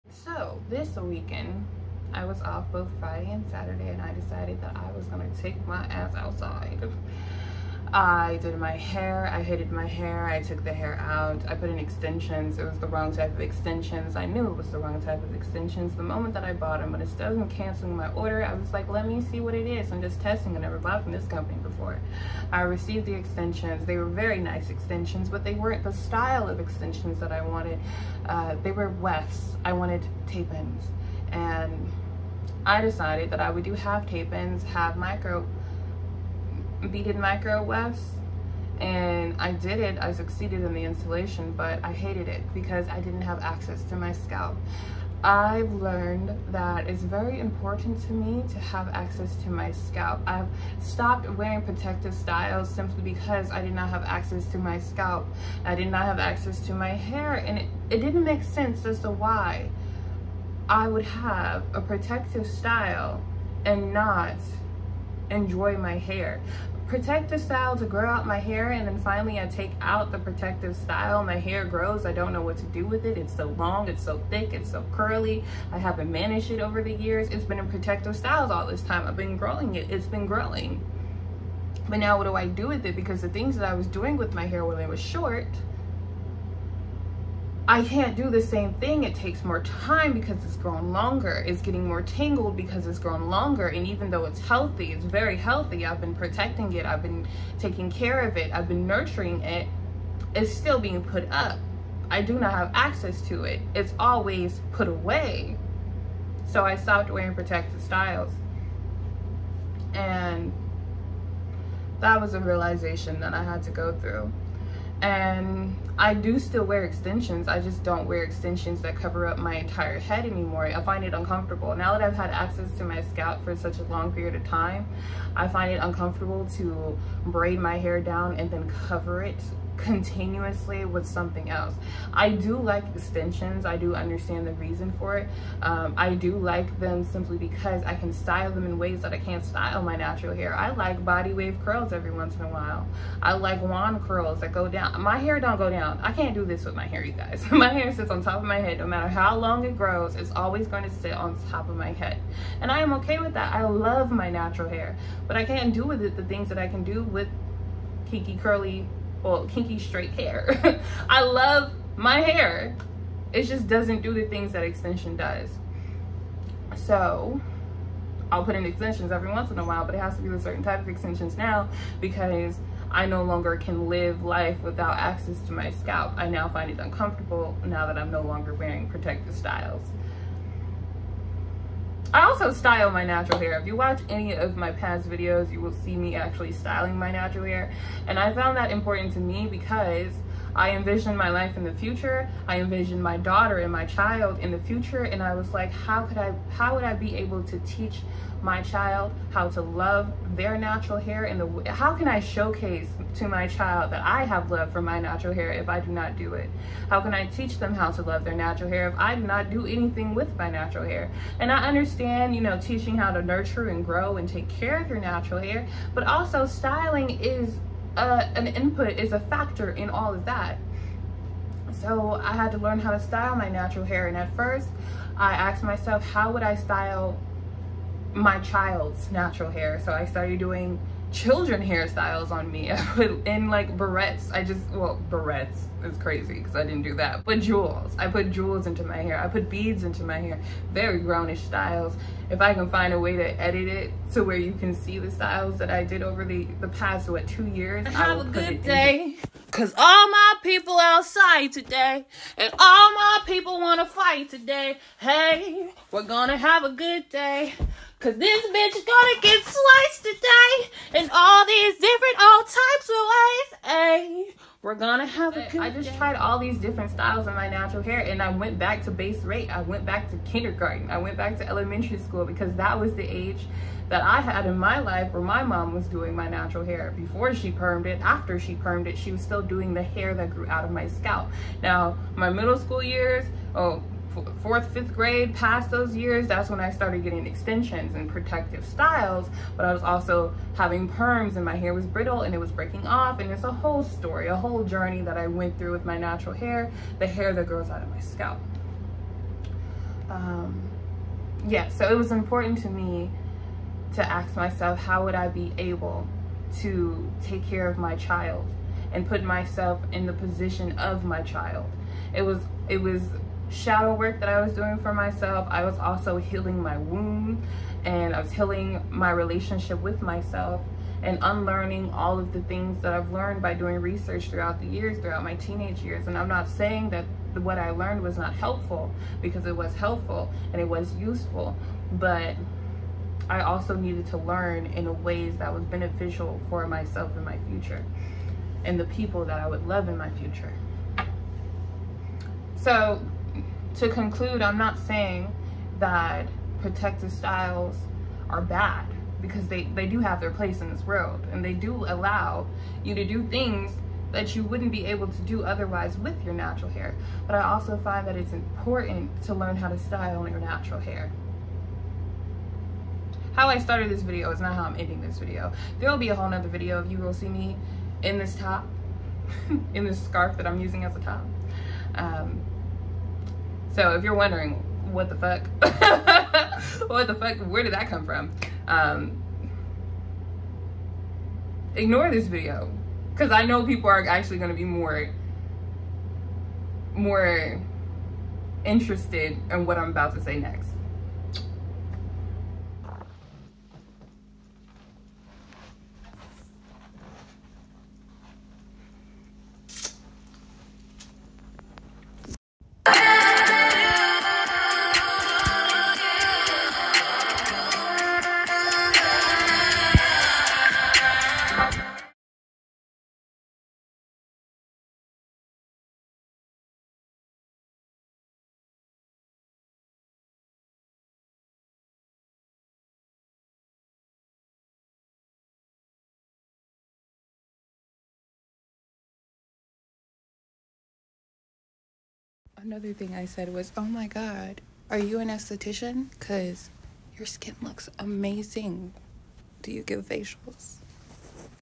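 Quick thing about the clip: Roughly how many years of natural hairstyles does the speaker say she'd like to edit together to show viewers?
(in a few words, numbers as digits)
2.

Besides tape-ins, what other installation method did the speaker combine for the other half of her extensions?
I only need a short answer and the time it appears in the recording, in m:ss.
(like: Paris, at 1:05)
micro beaded micro wefts, at 0:34.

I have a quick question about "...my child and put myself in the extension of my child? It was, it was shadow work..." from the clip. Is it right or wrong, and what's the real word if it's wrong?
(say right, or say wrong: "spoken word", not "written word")
wrong: "position", not "extension".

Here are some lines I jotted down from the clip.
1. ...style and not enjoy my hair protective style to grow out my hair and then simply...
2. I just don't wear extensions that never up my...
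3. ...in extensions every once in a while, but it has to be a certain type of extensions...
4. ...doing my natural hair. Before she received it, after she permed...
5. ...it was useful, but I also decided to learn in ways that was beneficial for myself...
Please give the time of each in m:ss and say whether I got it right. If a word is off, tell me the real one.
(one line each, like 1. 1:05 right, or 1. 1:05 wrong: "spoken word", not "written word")
1. 1:02 wrong: "finally", not "simply"
2. 1:57 wrong: "cover", not "never"
3. 2:48 right
4. 4:35 wrong: "permed", not "received"
5. 5:30 wrong: "needed", not "decided".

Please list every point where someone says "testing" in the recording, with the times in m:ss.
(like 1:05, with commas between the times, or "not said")
0:20.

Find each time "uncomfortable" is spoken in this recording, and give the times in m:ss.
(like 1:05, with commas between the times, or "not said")
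2:01, 2:05, 2:56.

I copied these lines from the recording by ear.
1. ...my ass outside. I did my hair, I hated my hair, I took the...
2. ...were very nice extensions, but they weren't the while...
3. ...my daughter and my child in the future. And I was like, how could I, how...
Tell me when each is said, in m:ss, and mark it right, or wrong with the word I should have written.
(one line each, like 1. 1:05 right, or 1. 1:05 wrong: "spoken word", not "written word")
1. 0:05 right
2. 0:23 wrong: "style", not "while"
3. 3:13 right.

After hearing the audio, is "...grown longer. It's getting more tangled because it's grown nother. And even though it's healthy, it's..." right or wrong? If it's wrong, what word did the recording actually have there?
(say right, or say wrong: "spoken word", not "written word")
wrong: "longer", not "nother".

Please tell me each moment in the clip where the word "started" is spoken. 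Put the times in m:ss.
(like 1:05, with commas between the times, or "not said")
3:50, 4:46, 6:03.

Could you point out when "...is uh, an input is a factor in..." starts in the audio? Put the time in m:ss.
3:37.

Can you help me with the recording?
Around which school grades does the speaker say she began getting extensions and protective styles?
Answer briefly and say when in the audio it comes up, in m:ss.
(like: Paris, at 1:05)
fourth, fifth grade, at 4:44.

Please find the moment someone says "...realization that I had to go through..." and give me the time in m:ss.
1:52.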